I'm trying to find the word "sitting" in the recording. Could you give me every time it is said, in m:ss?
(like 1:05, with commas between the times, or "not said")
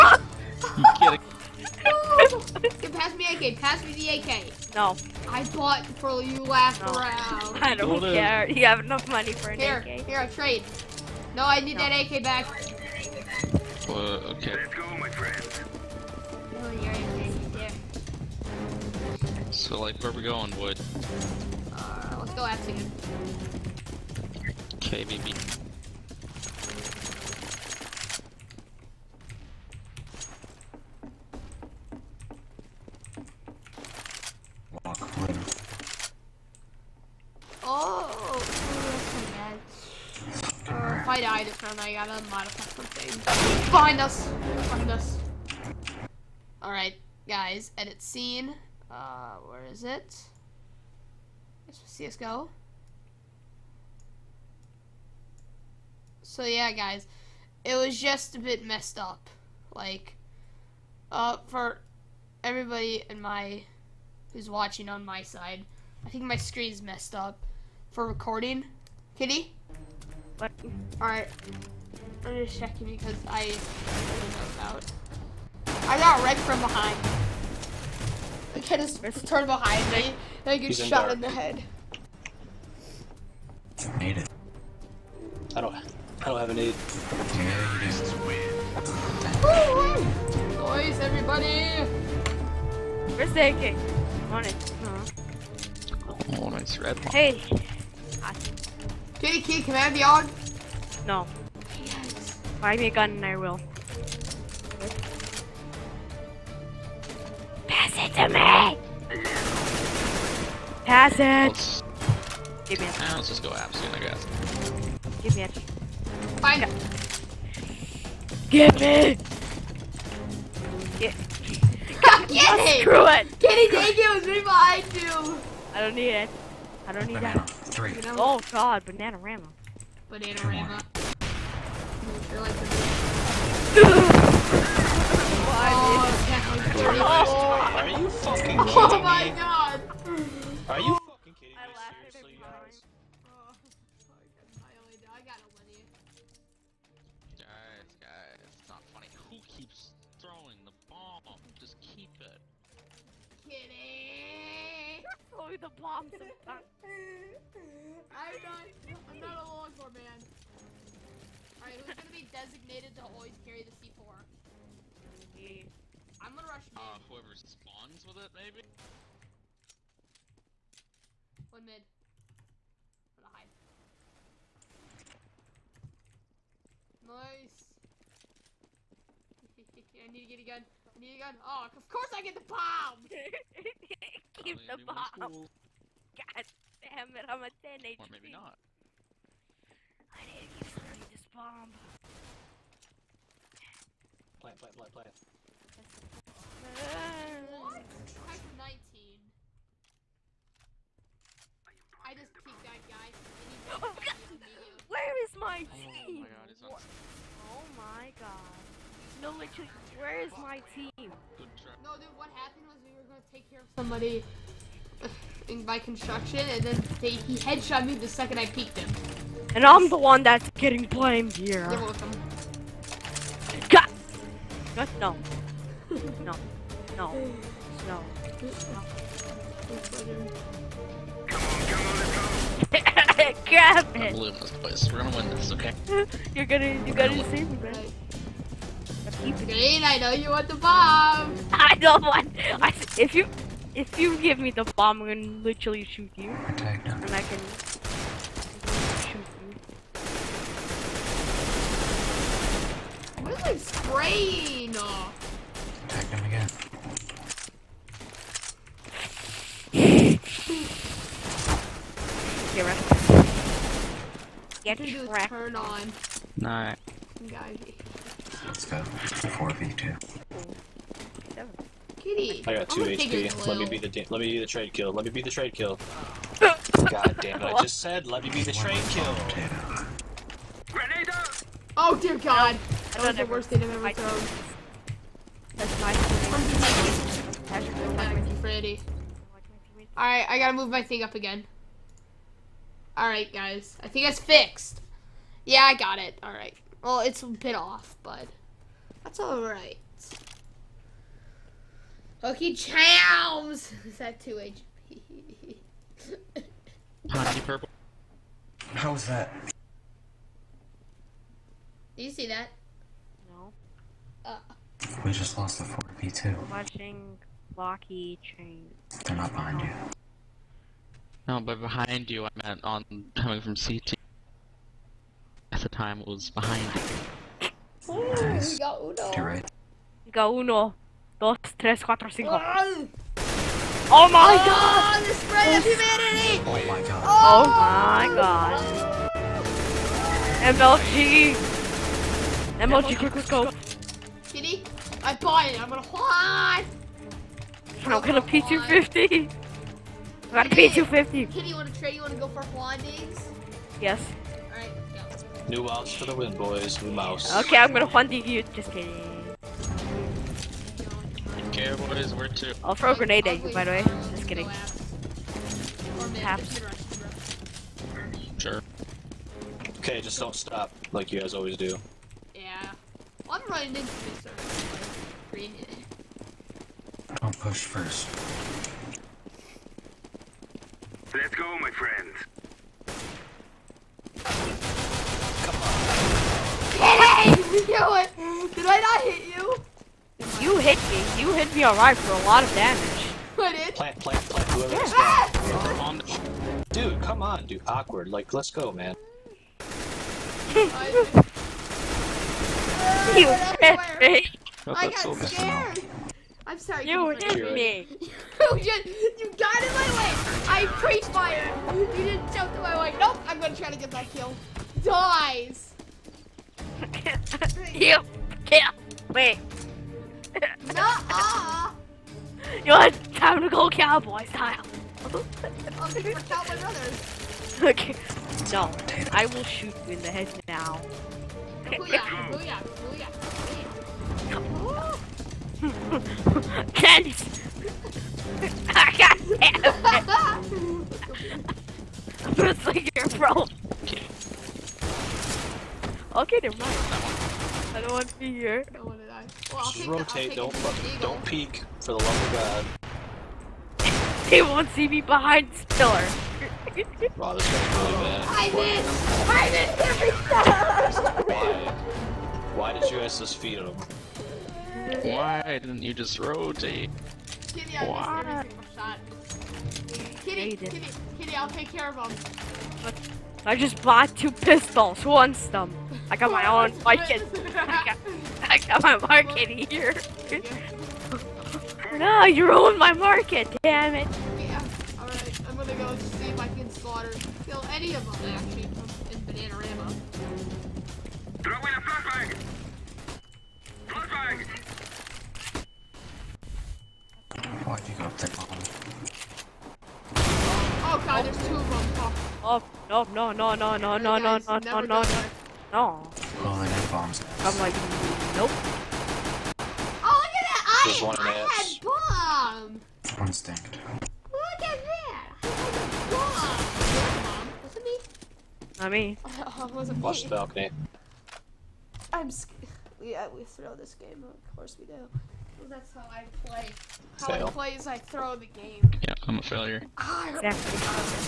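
not said.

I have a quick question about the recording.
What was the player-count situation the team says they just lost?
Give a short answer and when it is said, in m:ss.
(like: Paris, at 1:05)
4v2, at 5:15.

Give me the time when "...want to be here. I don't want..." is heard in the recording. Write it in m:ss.
7:27.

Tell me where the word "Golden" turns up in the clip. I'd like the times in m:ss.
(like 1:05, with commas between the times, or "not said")
0:07.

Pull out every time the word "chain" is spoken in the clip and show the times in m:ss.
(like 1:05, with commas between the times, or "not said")
5:18.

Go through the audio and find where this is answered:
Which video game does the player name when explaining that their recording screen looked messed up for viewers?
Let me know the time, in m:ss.
0:51.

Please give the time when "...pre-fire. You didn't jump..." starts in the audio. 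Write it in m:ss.
6:50.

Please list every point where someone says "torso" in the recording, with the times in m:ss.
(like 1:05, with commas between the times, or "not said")
not said.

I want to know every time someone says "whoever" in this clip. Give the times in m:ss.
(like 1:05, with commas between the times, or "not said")
2:46, 6:34.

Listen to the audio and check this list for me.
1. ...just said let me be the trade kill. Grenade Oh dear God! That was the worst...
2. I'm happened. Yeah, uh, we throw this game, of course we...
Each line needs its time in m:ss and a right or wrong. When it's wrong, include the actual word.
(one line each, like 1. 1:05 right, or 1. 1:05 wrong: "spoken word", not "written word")
1. 4:37 right
2. 8:42 wrong: "scared", not "happened".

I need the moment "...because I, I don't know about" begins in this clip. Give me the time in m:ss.
1:12.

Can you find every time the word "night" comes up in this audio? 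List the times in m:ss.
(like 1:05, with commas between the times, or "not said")
not said.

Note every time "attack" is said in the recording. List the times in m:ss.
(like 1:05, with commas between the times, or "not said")
4:06, 4:15.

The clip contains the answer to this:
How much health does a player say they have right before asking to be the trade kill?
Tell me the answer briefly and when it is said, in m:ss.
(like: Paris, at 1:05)
2 HP, at 4:32.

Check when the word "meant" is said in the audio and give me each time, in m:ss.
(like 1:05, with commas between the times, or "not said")
5:22.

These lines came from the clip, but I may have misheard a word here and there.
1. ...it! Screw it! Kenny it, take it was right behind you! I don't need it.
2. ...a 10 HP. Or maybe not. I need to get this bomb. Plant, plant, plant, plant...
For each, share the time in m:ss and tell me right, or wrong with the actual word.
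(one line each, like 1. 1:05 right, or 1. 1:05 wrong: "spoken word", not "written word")
1. 2:02 right
2. 3:07 right.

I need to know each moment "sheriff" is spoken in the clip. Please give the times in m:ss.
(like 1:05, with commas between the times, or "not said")
not said.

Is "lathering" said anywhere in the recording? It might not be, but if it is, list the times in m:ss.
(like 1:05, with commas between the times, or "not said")
not said.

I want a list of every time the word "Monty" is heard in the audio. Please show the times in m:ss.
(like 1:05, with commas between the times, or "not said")
5:07.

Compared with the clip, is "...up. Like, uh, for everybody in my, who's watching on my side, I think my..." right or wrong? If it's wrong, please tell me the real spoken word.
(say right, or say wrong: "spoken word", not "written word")
right.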